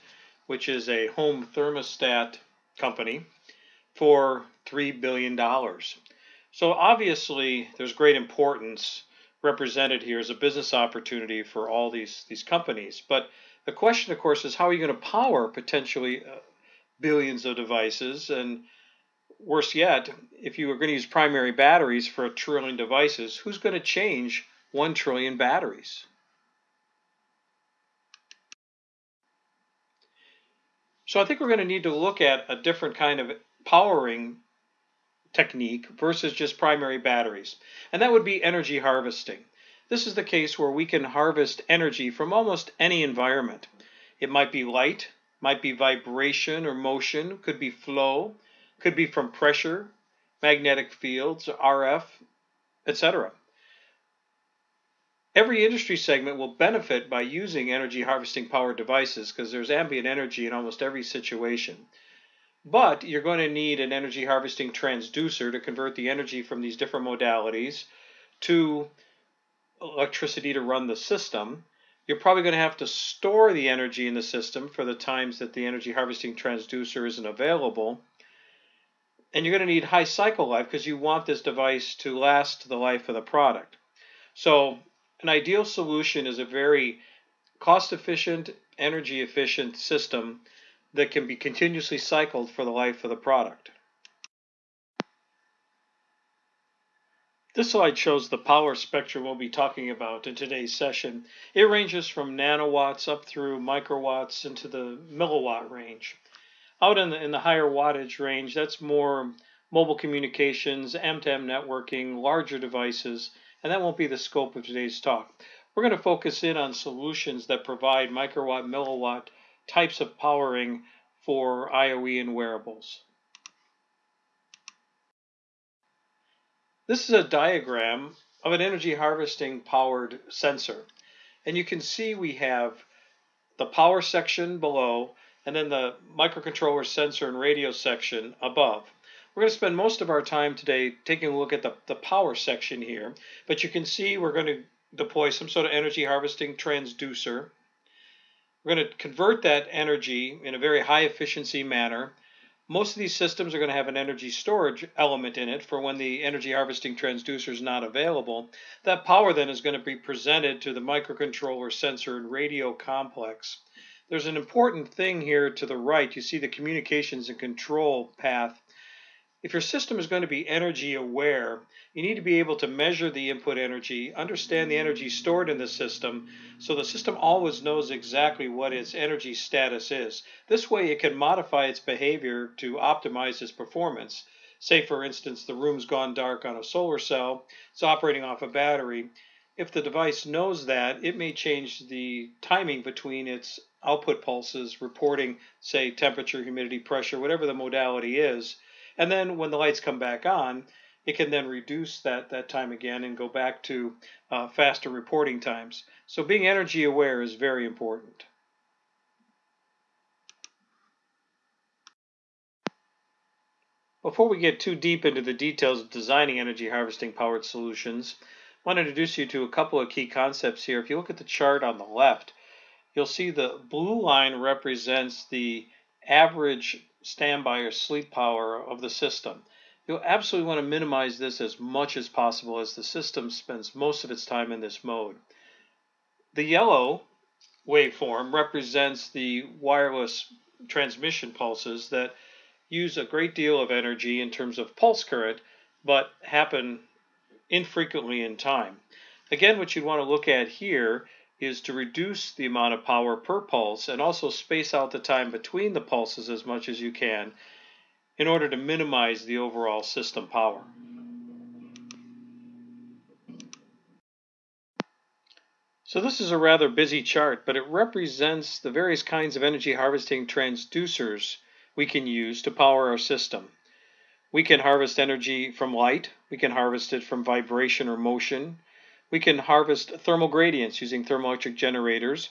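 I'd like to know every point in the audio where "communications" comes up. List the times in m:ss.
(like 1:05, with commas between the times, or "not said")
1:49, 2:46.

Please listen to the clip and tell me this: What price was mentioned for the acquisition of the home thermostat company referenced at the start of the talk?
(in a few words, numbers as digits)
$3 billion.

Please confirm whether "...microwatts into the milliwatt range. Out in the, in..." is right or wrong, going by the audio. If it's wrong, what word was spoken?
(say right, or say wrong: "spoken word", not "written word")
right.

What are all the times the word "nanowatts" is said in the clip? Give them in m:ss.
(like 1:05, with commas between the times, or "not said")
1:42.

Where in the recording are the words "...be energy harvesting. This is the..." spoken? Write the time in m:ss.
0:38.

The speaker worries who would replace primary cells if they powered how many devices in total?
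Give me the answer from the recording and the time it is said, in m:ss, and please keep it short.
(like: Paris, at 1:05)
1 trillion, at 0:24.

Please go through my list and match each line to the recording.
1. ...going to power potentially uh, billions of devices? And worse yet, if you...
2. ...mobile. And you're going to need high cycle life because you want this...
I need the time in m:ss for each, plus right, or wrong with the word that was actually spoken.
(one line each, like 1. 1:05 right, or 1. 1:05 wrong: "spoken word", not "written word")
1. 0:14 right
2. 1:17 wrong: "available", not "mobile".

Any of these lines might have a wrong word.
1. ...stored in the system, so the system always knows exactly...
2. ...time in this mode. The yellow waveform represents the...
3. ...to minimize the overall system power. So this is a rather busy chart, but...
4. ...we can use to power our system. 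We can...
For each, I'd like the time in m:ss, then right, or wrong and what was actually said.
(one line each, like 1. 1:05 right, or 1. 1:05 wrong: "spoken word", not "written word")
1. 2:55 right
2. 3:54 right
3. 4:18 right
4. 4:31 right.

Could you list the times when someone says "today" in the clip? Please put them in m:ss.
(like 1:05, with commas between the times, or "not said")
1:40, 1:54, 2:20.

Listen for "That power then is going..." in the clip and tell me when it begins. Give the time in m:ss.
2:38.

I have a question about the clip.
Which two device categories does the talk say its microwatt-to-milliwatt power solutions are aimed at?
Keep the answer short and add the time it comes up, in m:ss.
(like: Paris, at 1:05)
IOE and wearables, at 2:01.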